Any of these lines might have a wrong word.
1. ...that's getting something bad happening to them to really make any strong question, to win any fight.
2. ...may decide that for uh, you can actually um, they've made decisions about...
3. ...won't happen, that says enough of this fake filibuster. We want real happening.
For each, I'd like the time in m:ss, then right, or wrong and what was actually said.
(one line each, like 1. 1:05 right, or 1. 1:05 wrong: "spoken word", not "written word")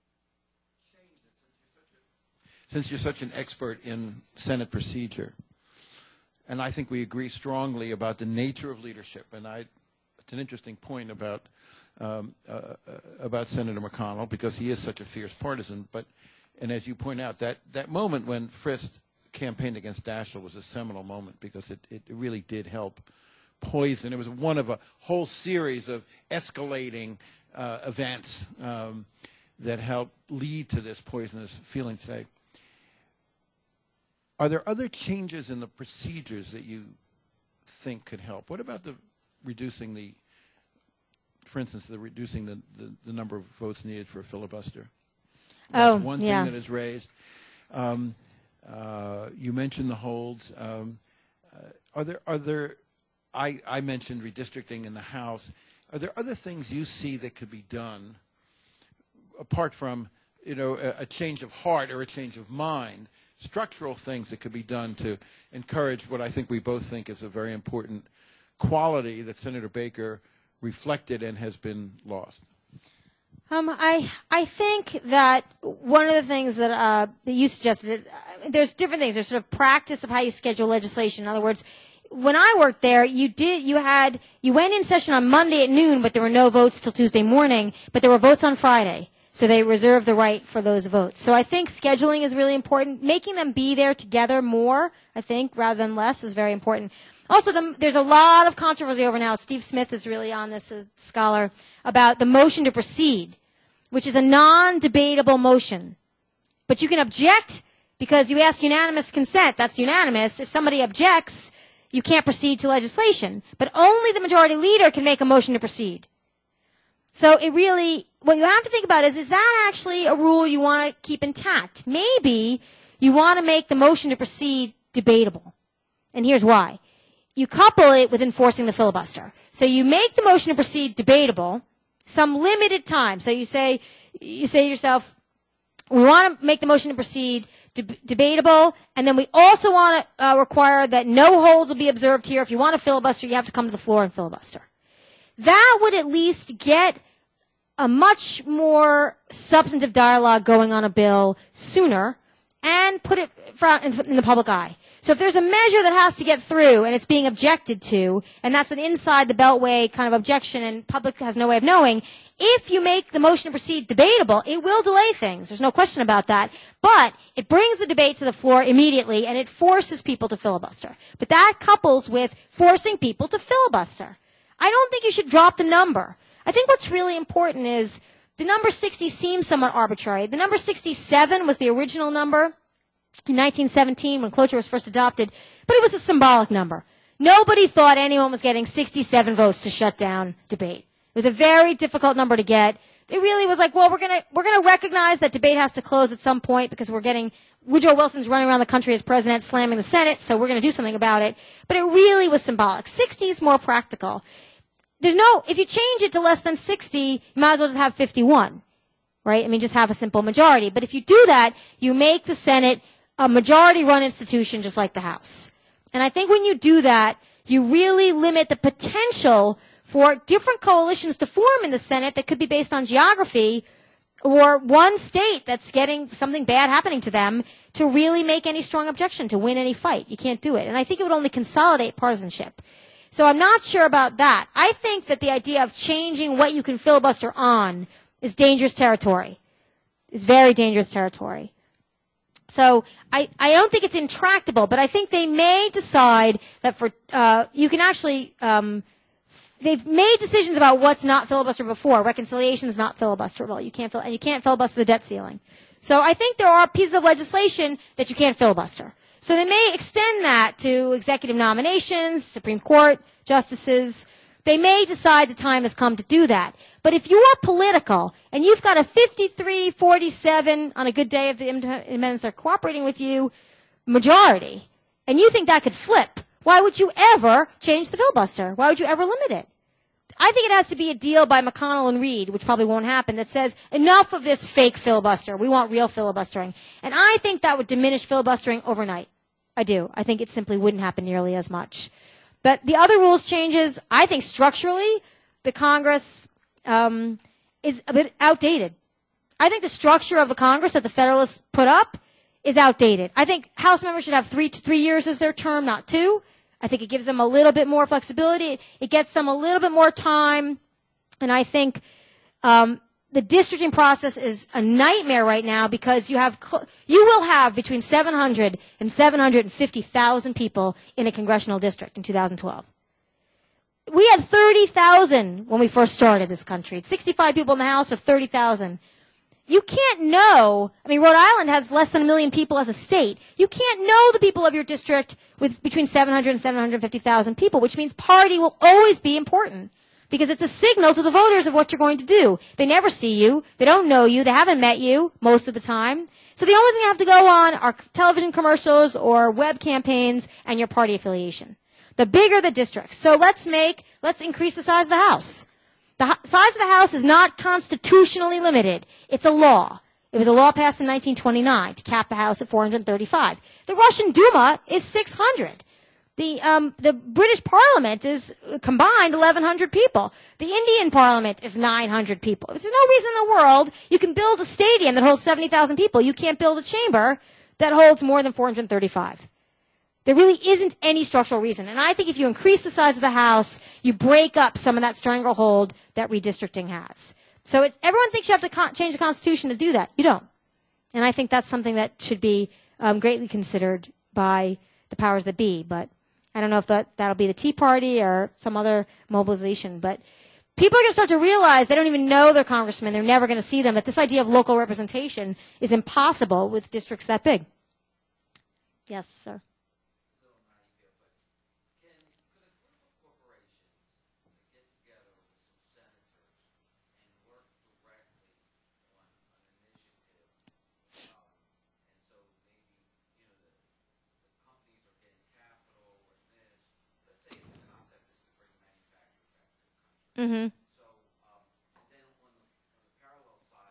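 1. 3:45 wrong: "objection", not "question"
2. 4:05 right
3. 4:42 wrong: "filibustering", not "happening".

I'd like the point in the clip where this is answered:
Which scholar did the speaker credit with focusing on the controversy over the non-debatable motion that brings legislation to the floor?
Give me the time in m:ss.
1:39.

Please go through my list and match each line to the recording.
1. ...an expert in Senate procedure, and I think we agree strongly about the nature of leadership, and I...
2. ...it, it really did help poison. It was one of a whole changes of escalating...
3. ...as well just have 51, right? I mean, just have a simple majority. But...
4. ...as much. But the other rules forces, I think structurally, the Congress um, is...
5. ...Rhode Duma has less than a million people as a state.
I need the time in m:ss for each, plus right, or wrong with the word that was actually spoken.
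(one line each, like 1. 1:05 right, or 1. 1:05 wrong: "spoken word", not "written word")
1. 0:03 right
2. 0:21 wrong: "series", not "changes"
3. 3:27 right
4. 4:51 wrong: "changes", not "forces"
5. 5:31 wrong: "Island", not "Duma".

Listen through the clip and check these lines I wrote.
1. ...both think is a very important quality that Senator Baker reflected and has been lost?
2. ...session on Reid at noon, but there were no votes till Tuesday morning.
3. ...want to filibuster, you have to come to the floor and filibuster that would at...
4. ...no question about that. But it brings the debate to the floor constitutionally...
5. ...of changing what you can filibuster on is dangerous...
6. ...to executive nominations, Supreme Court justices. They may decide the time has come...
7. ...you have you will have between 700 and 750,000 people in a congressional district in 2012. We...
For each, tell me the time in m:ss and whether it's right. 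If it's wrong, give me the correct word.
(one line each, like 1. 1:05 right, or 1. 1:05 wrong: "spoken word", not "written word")
1. 1:06 right
2. 1:24 wrong: "Monday", not "Reid"
3. 2:22 right
4. 2:45 wrong: "immediately", not "constitutionally"
5. 3:55 right
6. 4:20 right
7. 5:16 right.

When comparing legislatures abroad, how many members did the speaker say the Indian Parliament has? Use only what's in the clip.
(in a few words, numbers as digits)
900.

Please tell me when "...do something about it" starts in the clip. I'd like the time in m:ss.
3:20.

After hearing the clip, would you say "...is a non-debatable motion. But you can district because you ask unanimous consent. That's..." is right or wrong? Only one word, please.
wrong.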